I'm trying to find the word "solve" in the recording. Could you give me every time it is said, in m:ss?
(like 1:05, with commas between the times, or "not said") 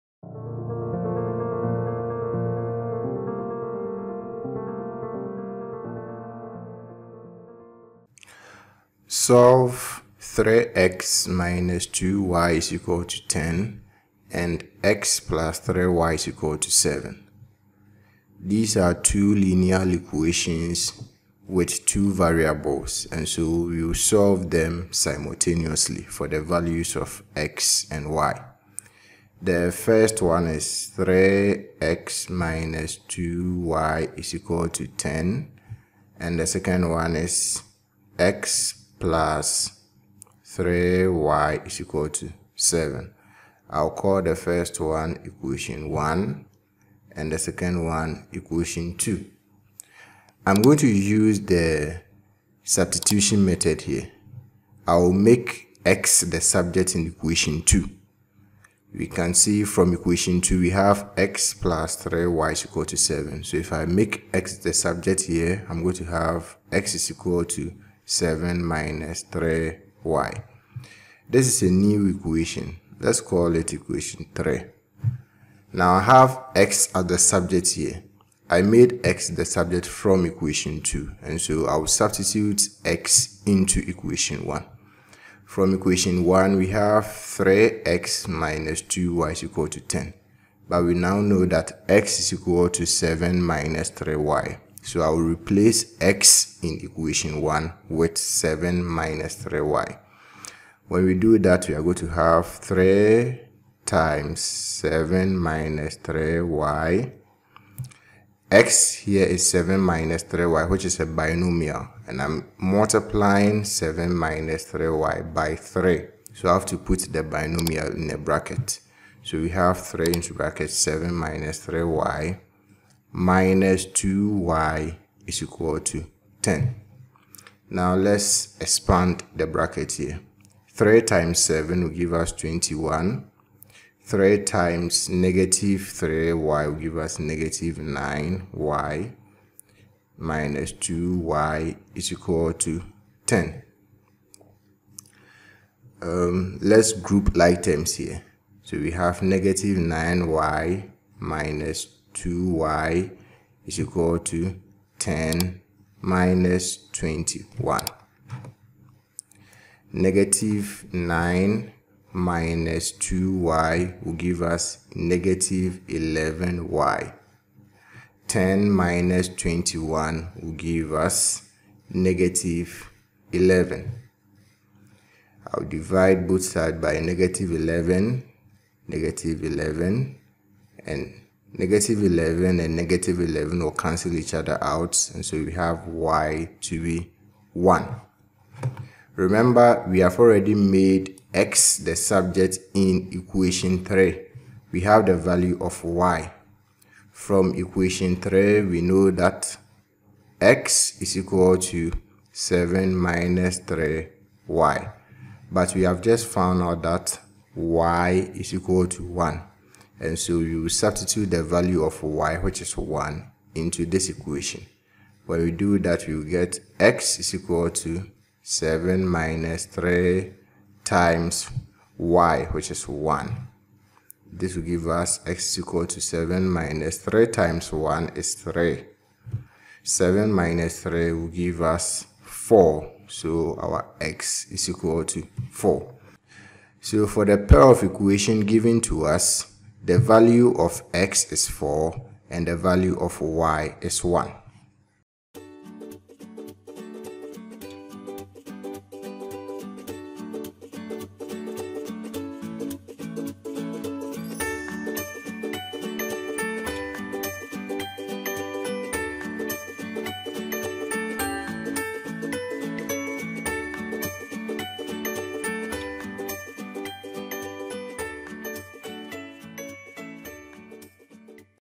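0:09, 0:23.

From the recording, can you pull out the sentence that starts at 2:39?
Negative 9 minus 2y will give us negative 11y.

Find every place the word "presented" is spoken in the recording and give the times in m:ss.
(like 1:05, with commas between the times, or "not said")
not said.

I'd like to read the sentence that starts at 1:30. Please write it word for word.
But we now know that x is equal to 7 minus 3y.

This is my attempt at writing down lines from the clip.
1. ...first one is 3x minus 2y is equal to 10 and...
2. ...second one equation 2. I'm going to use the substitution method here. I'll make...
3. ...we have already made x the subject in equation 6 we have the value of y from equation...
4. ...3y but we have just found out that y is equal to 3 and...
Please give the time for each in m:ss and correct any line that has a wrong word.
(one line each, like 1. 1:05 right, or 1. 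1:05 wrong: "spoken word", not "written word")
1. 0:29 right
2. 0:47 right
3. 3:09 wrong: "3", not "6"
4. 3:23 wrong: "1", not "3".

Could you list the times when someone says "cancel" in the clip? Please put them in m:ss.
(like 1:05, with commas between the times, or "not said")
3:03.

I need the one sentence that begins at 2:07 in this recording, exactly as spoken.
Now let's expand the bracket here.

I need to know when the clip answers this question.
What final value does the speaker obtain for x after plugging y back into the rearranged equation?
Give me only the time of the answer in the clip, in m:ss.
3:54.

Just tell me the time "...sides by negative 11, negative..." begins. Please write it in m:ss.
2:56.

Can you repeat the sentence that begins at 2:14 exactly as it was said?
3 times negative 3y will give us negative 9y minus 2y is equal to 10.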